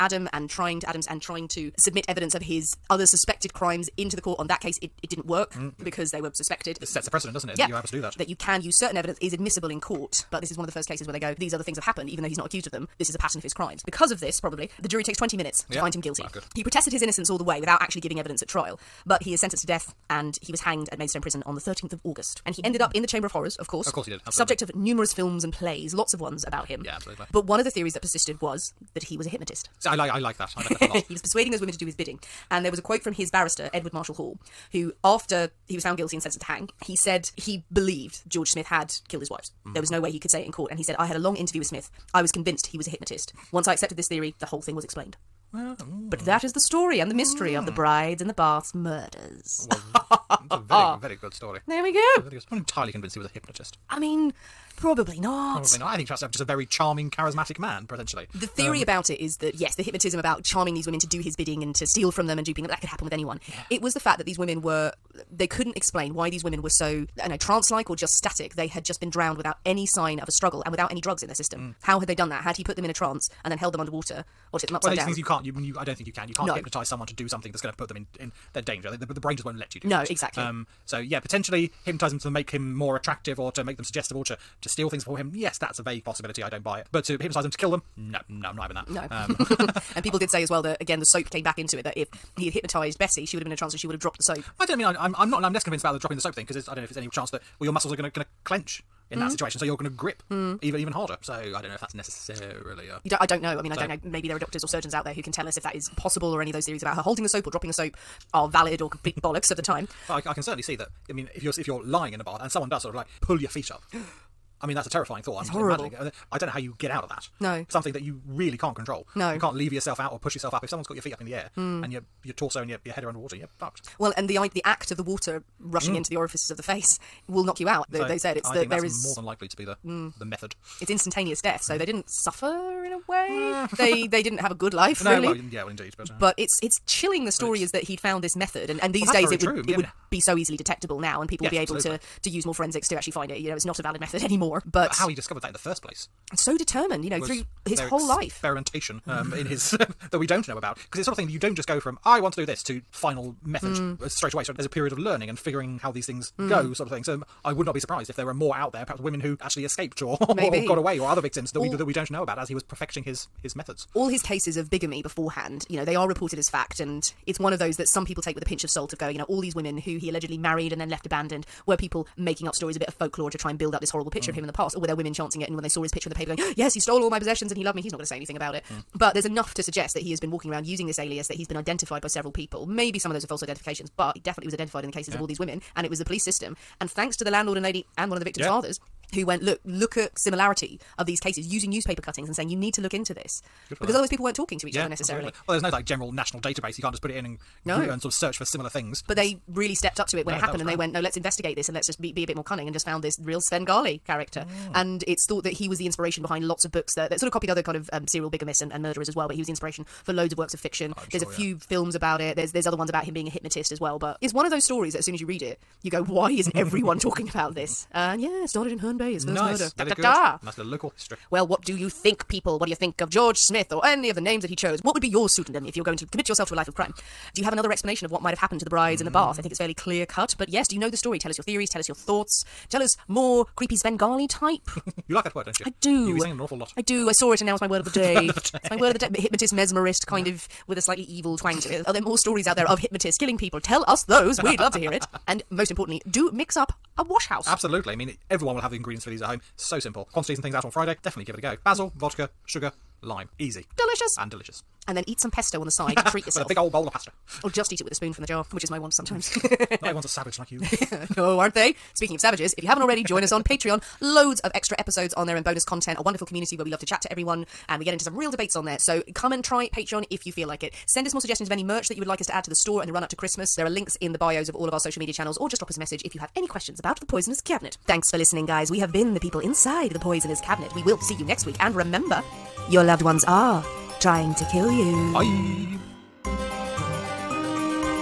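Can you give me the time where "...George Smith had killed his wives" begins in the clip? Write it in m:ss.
0:38.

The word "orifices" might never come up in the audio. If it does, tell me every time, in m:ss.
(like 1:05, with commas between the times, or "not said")
2:06.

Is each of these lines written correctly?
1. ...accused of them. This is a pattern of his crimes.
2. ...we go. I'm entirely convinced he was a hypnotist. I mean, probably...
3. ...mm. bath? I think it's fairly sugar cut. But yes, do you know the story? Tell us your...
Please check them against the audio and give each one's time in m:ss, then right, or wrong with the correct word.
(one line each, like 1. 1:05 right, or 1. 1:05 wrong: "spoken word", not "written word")
1. 0:12 right
2. 0:51 right
3. 3:49 wrong: "clear", not "sugar".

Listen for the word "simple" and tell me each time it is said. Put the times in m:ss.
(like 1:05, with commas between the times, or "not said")
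4:09.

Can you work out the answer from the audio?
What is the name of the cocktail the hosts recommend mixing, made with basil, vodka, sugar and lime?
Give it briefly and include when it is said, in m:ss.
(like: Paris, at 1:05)
Wash House, at 4:07.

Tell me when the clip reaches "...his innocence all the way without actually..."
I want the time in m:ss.
0:16.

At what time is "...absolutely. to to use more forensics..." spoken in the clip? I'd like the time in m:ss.
2:21.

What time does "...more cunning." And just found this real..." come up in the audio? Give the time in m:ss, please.
3:22.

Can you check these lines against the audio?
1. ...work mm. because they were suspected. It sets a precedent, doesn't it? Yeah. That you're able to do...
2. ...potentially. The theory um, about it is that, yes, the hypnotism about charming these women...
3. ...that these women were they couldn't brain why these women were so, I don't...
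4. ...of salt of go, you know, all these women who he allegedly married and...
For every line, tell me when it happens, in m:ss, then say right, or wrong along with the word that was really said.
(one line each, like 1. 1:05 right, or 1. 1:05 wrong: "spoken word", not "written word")
1. 0:05 right
2. 0:57 right
3. 1:04 wrong: "explain", not "brain"
4. 2:48 right.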